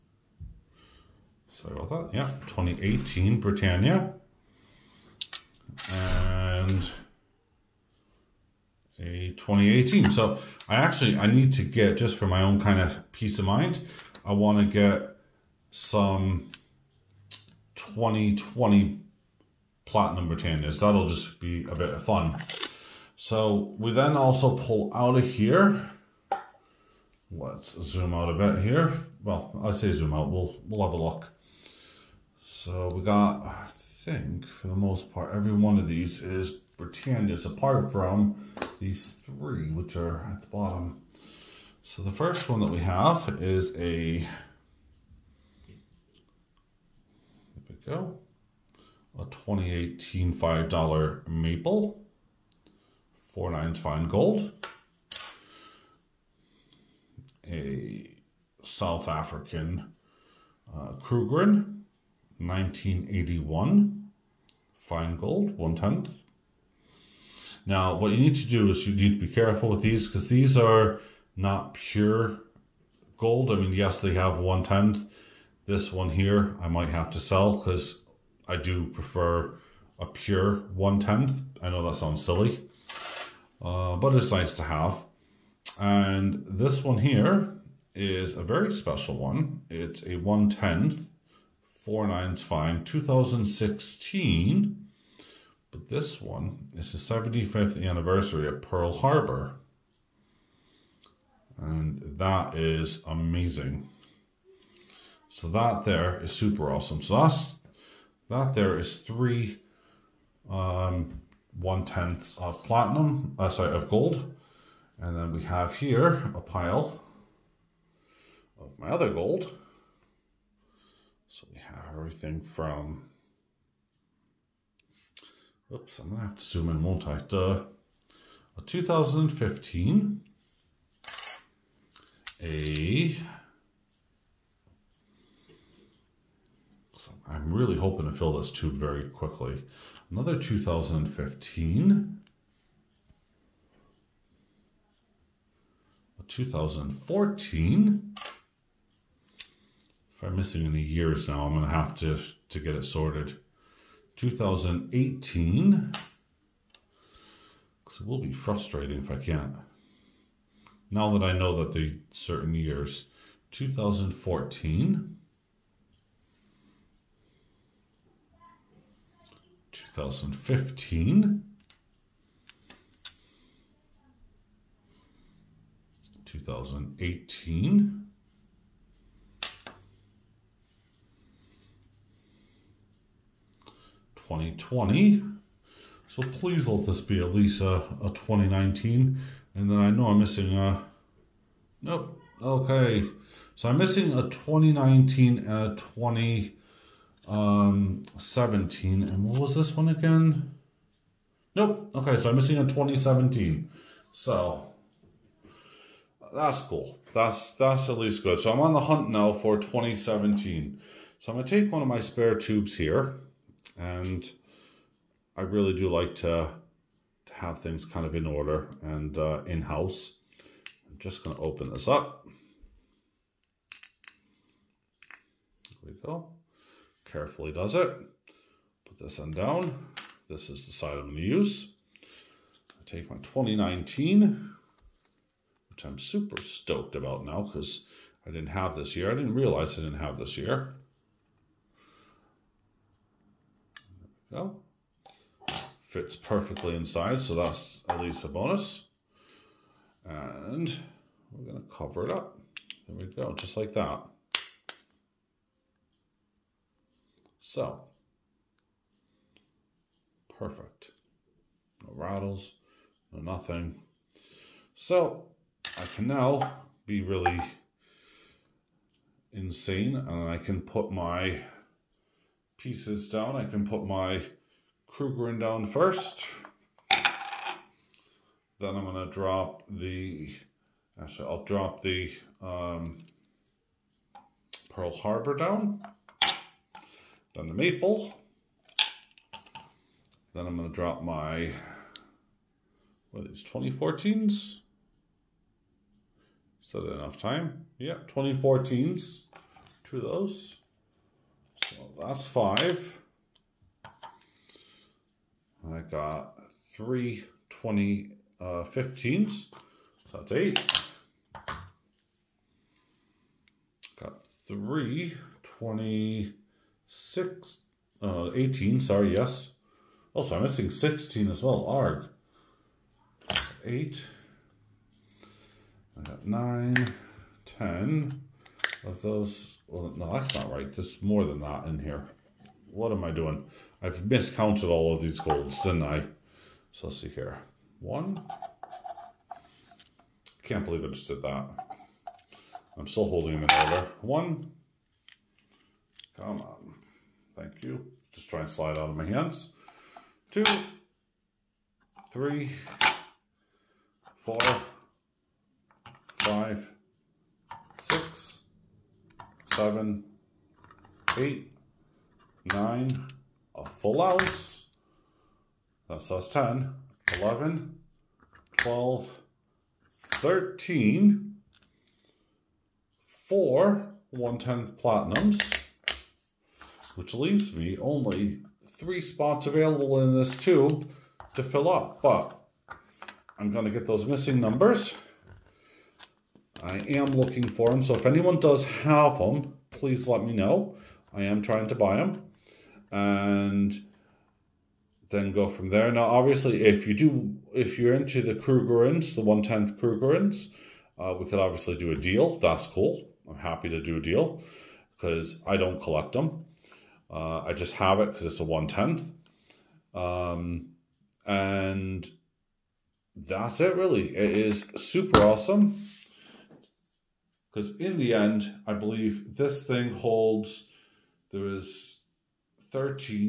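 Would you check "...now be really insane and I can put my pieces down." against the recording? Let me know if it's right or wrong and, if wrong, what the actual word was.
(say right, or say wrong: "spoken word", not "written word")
right.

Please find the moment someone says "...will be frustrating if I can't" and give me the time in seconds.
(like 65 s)
158 s.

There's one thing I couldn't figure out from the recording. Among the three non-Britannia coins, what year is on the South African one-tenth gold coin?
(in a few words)
1981.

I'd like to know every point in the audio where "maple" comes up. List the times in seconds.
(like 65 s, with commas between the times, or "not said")
51 s, 287 s.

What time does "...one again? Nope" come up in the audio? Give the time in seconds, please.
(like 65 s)
199 s.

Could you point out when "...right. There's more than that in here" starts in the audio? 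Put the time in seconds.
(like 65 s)
330 s.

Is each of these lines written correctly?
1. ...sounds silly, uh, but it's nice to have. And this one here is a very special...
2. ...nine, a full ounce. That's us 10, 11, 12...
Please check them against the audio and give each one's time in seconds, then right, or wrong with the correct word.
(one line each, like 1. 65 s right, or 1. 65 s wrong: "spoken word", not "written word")
1. 81 s right
2. 362 s right.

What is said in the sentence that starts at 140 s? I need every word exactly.
Another 2015, a 2014, I'm missing any years now, I'm going to have to, to get it sorted.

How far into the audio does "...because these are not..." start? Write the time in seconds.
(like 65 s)
70 s.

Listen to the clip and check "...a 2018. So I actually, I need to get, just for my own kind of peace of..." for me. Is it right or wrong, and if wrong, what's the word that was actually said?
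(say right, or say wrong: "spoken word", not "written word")
right.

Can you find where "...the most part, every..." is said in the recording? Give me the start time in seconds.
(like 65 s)
34 s.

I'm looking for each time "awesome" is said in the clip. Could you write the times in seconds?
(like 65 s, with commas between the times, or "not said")
106 s, 415 s.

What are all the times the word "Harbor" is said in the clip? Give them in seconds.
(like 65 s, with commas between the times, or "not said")
98 s, 284 s.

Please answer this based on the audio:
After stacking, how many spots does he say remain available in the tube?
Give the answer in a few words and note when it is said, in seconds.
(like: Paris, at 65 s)
3, at 378 s.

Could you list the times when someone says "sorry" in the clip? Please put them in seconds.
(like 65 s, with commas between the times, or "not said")
1 s, 113 s, 318 s.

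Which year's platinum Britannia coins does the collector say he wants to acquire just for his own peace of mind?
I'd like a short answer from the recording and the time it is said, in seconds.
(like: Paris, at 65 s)
2020, at 17 s.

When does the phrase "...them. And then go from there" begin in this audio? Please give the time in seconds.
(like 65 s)
391 s.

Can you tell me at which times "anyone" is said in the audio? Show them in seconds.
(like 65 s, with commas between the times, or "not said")
388 s.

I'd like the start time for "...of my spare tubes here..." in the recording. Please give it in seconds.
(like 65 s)
211 s.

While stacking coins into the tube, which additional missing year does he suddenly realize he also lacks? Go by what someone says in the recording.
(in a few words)
2016.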